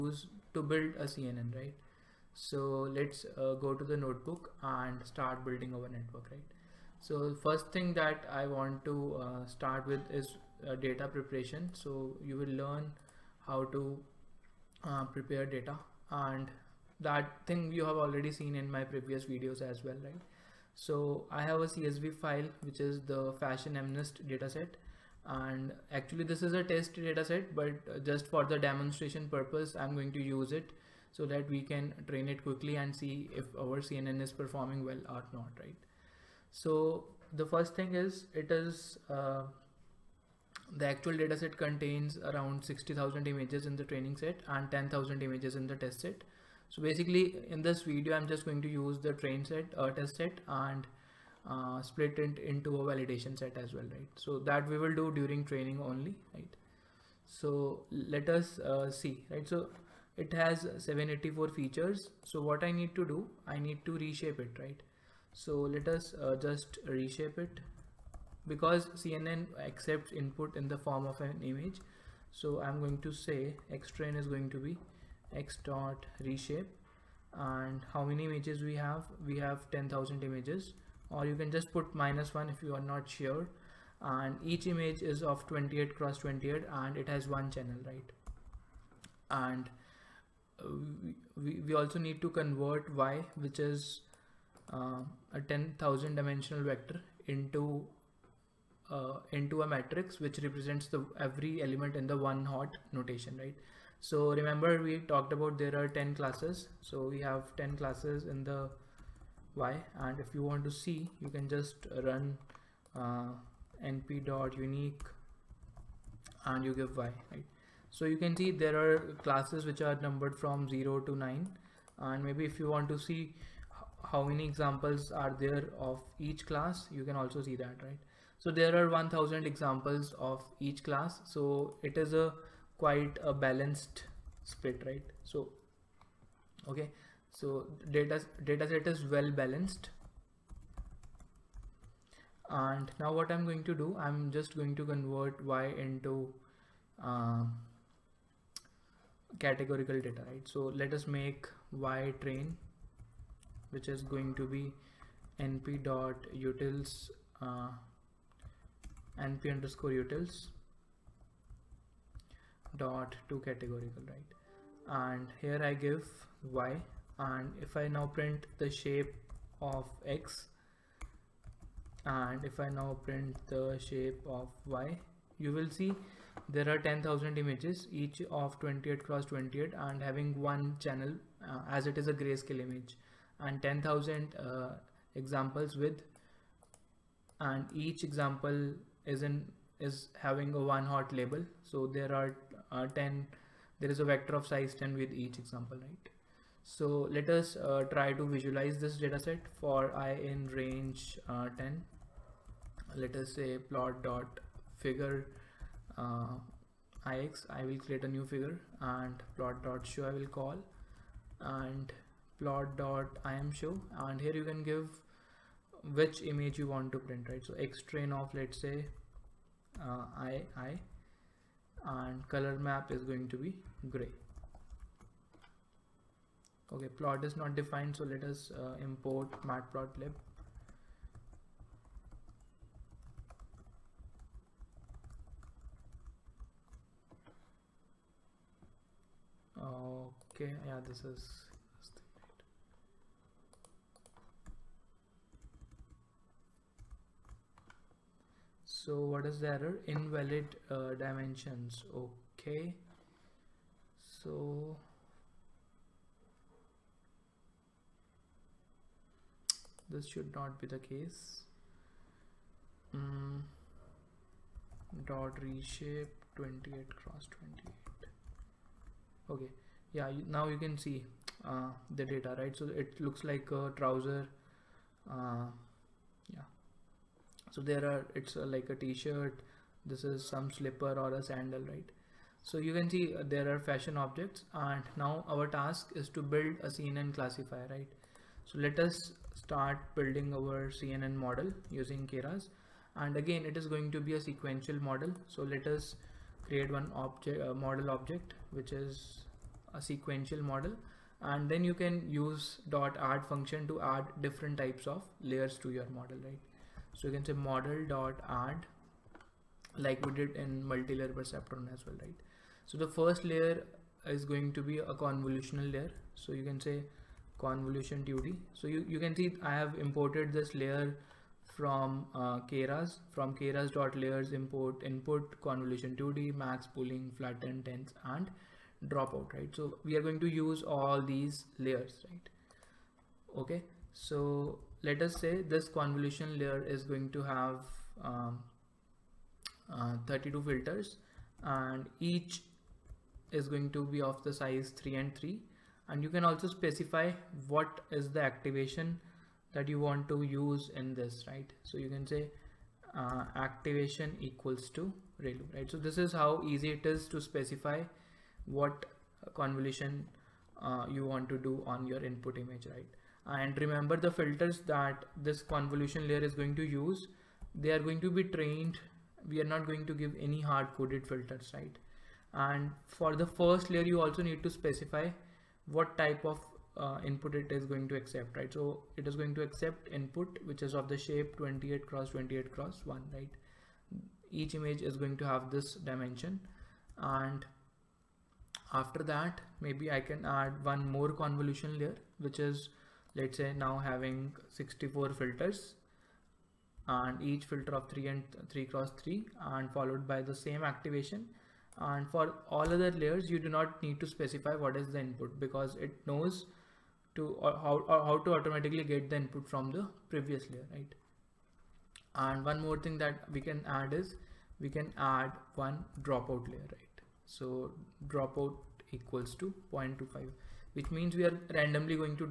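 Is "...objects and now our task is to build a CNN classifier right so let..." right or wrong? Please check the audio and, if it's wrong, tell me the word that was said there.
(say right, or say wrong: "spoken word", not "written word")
right.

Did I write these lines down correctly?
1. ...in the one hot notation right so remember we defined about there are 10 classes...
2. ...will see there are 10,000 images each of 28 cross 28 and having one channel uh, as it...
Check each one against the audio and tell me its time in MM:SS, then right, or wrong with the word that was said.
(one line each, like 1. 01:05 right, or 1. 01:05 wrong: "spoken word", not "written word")
1. 01:41 wrong: "talked", not "defined"
2. 02:55 right.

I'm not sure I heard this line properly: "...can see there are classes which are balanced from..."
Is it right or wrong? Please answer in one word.
wrong.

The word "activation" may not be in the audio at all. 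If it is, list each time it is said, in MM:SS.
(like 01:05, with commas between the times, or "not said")
05:48, 05:53, 06:40.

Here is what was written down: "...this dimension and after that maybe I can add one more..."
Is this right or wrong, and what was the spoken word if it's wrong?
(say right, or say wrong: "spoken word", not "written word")
right.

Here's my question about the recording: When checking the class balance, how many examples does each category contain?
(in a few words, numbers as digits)
1000.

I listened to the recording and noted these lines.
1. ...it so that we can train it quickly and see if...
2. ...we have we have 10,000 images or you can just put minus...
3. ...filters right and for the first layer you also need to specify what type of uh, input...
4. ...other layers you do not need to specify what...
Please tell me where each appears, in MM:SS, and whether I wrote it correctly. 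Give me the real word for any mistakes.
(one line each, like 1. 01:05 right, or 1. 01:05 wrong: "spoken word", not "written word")
1. 00:30 right
2. 01:18 right
3. 06:11 right
4. 06:42 right.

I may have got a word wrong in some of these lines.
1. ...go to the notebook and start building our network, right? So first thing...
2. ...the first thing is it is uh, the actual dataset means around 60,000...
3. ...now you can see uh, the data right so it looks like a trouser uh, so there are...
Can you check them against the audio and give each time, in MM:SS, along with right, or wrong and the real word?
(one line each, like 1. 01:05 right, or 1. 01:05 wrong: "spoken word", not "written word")
1. 00:03 right
2. 00:37 wrong: "contains", not "means"
3. 04:30 right.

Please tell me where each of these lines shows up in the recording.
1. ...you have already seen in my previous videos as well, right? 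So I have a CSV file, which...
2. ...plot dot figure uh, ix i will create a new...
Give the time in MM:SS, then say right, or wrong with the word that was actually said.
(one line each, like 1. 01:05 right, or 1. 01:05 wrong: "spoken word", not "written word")
1. 00:17 right
2. 03:23 right.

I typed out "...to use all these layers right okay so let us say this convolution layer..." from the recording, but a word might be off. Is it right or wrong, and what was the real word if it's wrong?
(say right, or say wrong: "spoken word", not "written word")
right.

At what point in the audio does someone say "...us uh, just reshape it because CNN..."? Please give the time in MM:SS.
01:05.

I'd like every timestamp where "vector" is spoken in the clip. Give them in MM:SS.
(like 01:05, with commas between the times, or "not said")
01:36, 03:14.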